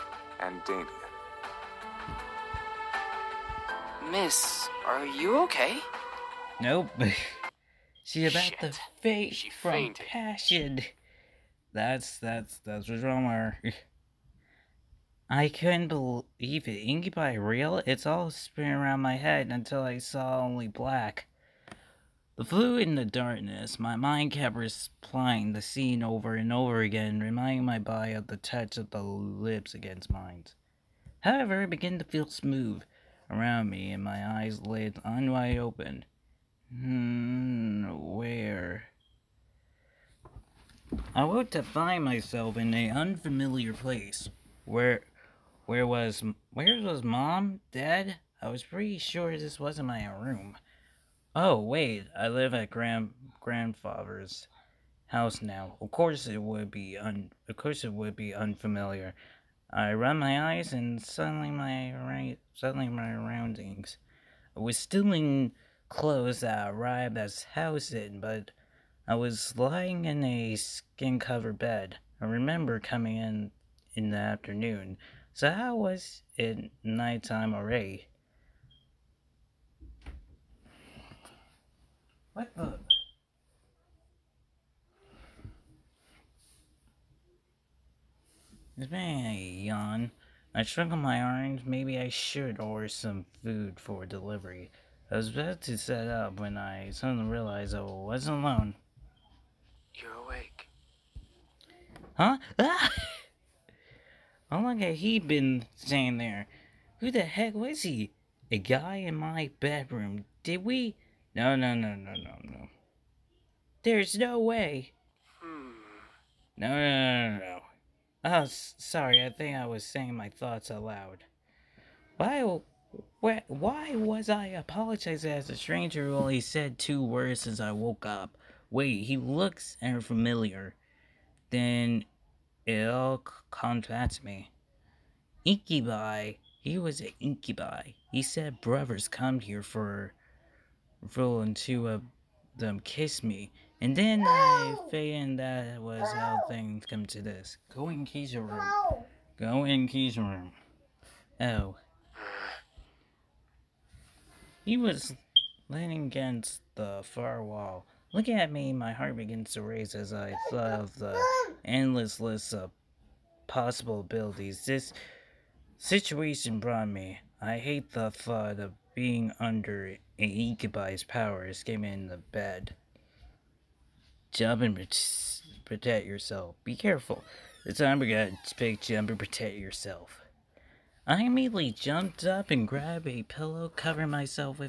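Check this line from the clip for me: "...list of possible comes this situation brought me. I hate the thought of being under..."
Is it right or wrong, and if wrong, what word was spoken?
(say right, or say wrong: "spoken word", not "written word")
wrong: "abilities", not "comes".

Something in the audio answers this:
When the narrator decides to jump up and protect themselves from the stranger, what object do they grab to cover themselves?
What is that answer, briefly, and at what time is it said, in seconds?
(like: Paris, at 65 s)
a pillow, at 183 s.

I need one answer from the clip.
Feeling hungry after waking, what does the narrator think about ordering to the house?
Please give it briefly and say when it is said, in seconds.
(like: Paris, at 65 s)
food for delivery, at 93 s.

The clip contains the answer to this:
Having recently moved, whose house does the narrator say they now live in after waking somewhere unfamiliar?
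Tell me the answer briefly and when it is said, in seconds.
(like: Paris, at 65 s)
grandfather's house, at 52 s.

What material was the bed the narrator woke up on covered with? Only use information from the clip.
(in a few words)
skin.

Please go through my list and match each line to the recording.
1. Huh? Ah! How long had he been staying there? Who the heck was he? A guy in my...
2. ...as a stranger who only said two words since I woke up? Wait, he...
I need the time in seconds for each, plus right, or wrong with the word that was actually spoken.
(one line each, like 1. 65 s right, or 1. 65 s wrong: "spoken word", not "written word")
1. 102 s right
2. 125 s right.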